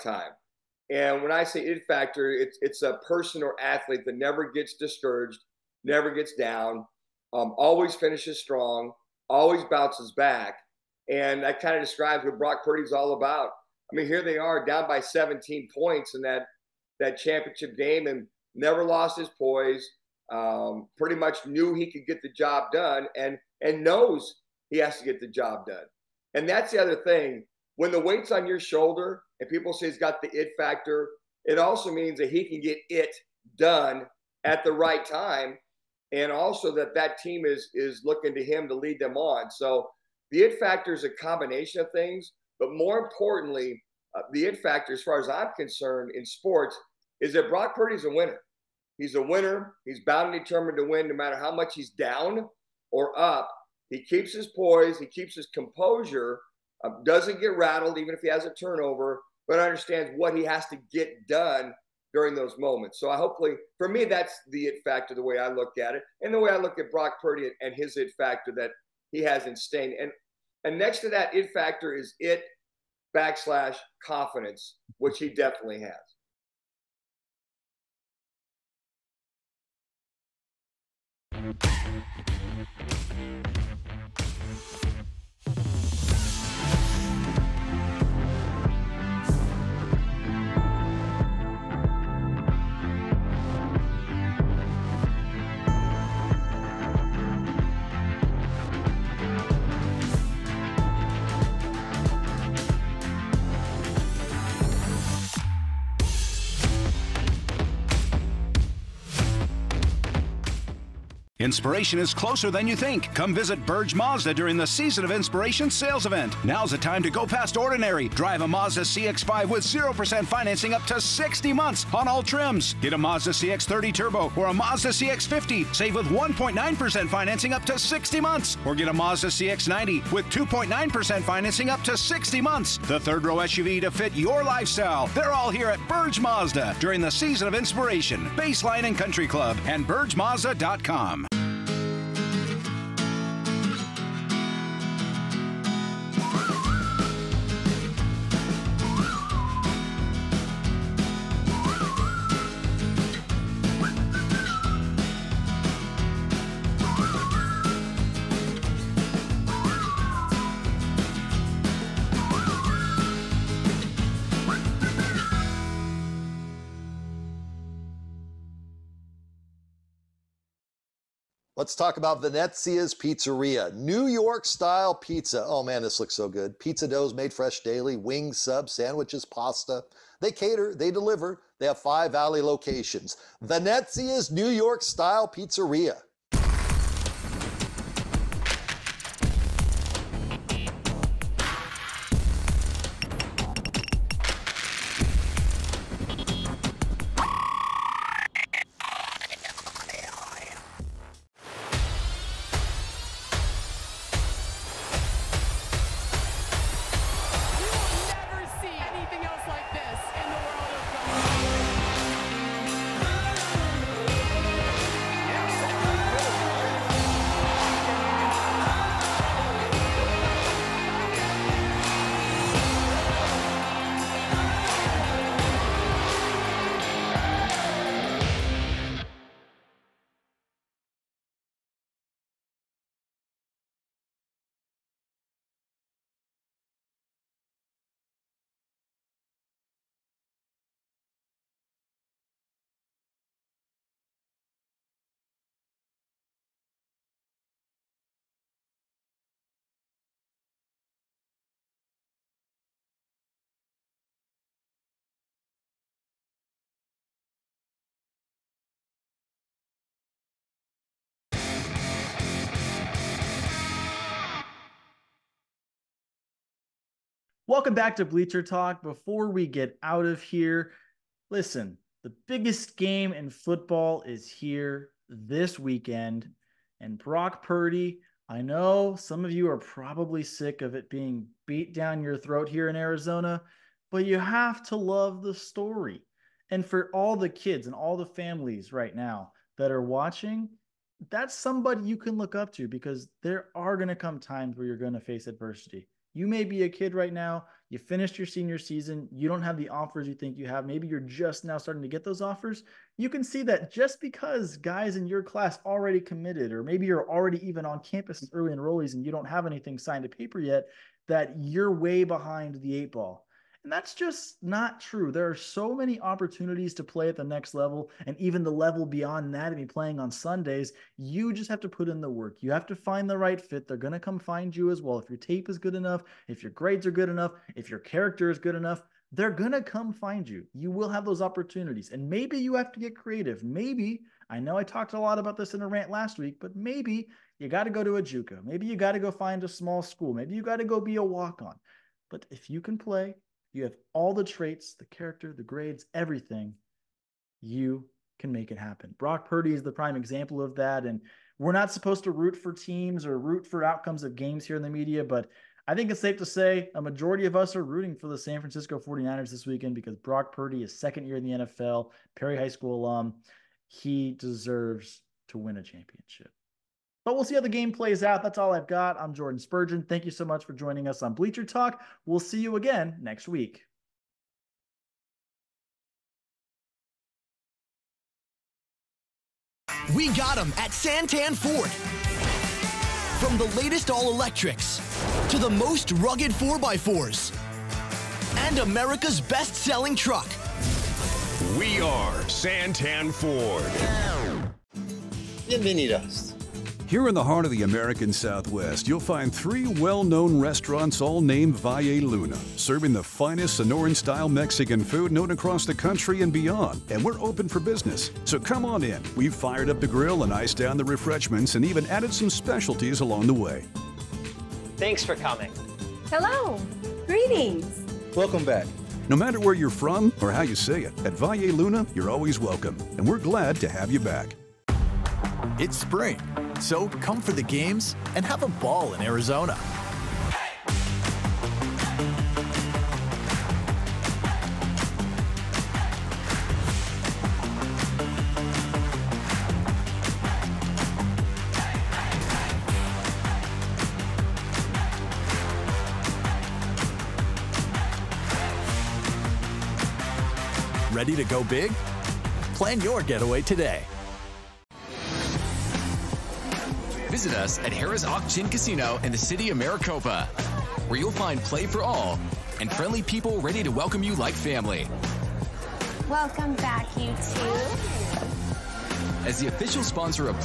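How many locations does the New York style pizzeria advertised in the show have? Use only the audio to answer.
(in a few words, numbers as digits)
5.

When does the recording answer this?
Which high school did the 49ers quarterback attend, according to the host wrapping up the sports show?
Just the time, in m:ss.
6:02.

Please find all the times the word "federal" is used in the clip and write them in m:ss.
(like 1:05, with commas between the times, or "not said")
not said.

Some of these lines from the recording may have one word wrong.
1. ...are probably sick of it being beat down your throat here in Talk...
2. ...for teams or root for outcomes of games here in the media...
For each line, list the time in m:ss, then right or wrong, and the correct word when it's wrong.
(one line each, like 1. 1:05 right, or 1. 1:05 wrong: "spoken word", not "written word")
1. 4:39 wrong: "Arizona", not "Talk"
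2. 5:52 right.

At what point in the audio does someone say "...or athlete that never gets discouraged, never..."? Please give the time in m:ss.
0:03.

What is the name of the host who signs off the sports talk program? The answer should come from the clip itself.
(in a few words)
Jordan Spurgeon.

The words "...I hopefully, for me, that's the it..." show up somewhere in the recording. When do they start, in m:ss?
1:03.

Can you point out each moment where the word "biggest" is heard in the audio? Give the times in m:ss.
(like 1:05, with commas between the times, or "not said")
4:32.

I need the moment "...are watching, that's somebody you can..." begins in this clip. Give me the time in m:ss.
4:49.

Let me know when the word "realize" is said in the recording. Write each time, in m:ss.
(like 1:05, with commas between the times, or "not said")
not said.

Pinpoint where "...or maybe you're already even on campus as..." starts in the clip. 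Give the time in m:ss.
5:06.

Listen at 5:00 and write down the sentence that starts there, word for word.
Maybe you're just now starting to get those offers.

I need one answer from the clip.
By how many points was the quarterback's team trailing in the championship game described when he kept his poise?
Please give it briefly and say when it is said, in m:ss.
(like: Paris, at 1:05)
17, at 0:14.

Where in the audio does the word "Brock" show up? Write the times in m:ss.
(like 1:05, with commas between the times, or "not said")
0:12, 0:47, 1:06, 4:36, 5:48, 5:59.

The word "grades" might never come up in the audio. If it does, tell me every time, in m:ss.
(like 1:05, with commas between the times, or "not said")
5:26, 5:45.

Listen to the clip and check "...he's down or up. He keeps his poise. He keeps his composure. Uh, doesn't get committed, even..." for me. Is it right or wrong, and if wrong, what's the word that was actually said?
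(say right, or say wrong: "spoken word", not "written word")
wrong: "rattled", not "committed".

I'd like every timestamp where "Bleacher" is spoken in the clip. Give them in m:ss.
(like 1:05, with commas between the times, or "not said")
4:28, 6:11.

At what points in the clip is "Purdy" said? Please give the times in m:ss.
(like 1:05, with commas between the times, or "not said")
0:12, 0:47, 1:07, 4:37, 5:49, 6:00.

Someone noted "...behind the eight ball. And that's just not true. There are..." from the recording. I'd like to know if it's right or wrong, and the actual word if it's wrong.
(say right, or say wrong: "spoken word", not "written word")
right.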